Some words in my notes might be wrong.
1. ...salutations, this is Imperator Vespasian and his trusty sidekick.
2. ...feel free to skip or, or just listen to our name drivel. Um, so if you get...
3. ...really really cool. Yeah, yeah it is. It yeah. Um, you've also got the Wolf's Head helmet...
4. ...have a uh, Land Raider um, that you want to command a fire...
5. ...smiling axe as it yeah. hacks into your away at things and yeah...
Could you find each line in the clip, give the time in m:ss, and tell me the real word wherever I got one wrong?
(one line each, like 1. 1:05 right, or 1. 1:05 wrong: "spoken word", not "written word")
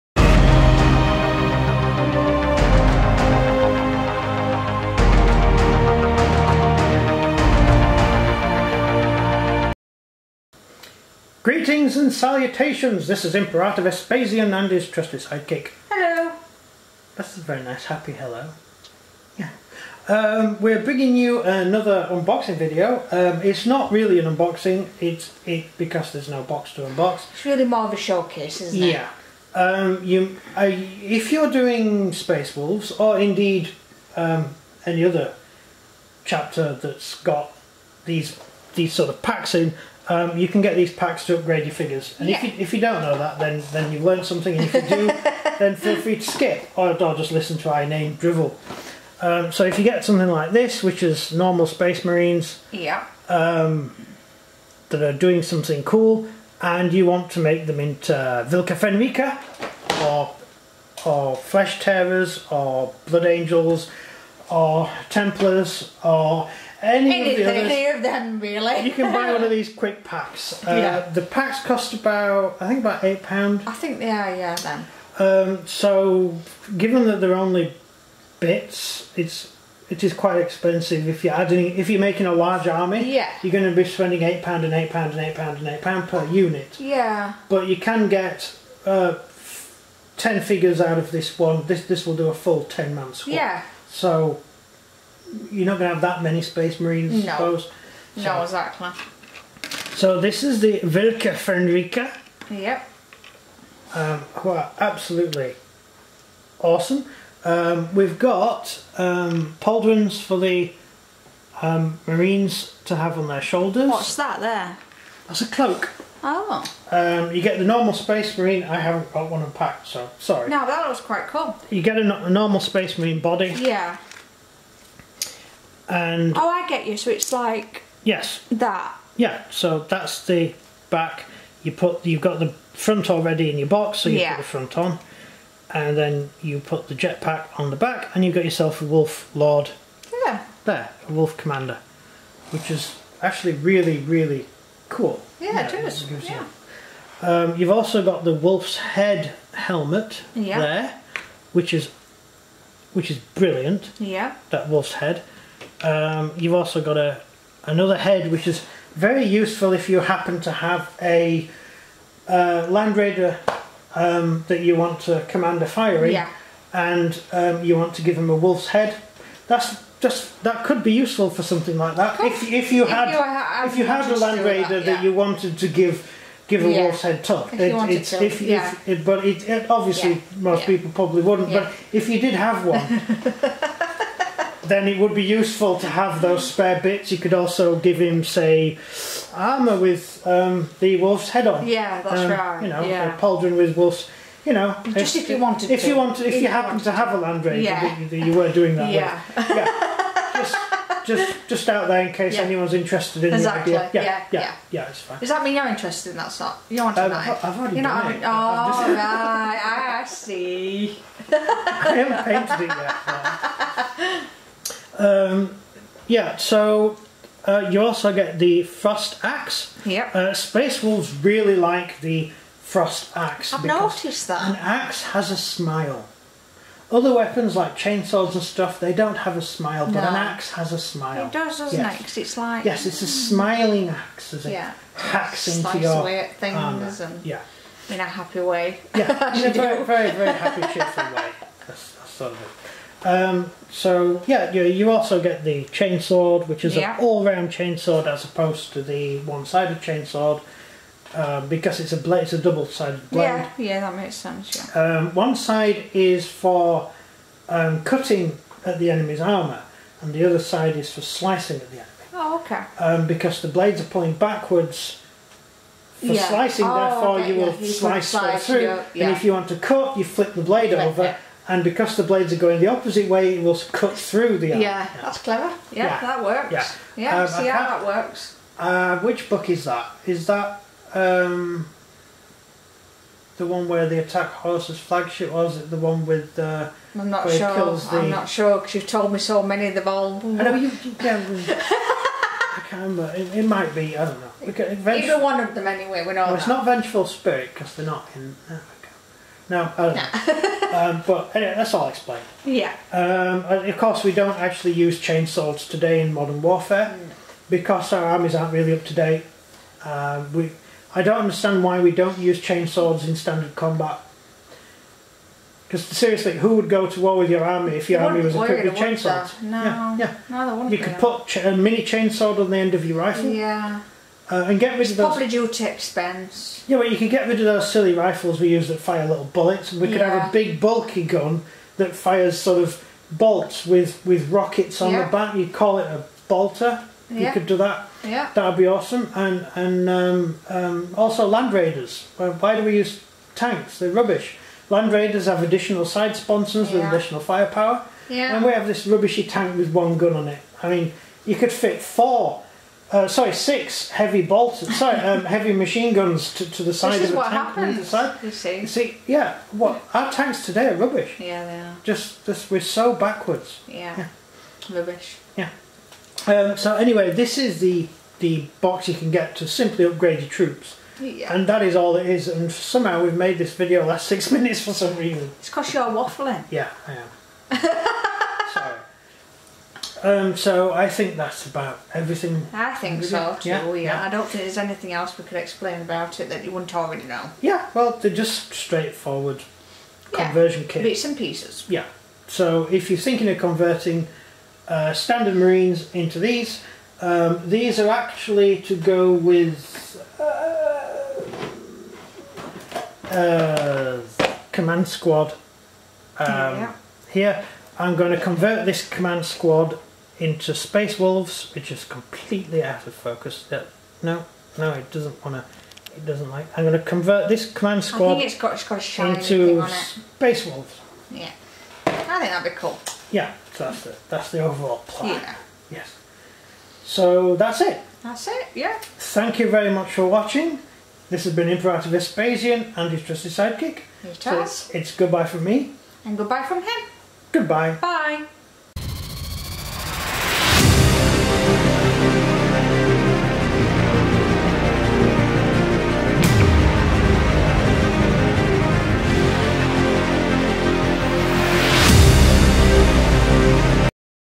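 1. 0:12 right
2. 0:45 right
3. 2:23 right
4. 2:40 right
5. 3:53 right.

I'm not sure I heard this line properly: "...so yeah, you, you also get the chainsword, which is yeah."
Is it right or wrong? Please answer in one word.
right.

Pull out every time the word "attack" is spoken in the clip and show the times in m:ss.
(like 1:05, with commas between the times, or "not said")
4:43.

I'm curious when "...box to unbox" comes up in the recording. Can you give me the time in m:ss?
0:26.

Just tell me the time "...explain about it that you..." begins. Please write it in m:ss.
6:25.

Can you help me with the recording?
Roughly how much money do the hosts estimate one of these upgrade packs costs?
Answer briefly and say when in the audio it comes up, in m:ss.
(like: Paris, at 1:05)
8 pounds, at 1:12.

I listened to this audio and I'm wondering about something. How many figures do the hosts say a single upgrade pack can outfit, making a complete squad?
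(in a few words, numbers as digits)
10.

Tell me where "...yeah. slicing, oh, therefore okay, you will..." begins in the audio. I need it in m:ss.
4:26.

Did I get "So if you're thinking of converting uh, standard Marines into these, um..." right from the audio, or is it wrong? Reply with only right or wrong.
right.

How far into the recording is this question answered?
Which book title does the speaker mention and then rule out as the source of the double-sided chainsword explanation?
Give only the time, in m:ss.
4:56.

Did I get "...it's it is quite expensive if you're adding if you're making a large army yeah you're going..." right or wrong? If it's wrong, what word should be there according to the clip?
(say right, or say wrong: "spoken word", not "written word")
right.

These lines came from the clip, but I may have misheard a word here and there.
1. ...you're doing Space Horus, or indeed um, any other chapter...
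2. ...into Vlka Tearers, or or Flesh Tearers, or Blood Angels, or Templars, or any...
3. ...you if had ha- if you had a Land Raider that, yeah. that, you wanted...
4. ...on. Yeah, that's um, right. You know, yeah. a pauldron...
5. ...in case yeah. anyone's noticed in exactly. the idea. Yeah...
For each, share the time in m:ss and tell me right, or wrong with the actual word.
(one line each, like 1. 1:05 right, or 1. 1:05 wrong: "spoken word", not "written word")
1. 0:31 wrong: "Wolves", not "Horus"
2. 0:57 wrong: "Fenryka", not "Tearers"
3. 2:52 right
4. 3:11 right
5. 3:22 wrong: "interested", not "noticed".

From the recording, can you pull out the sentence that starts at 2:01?
You get a, a normal Space Marine body.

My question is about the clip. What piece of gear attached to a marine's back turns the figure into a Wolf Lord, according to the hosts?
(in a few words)
jetpack.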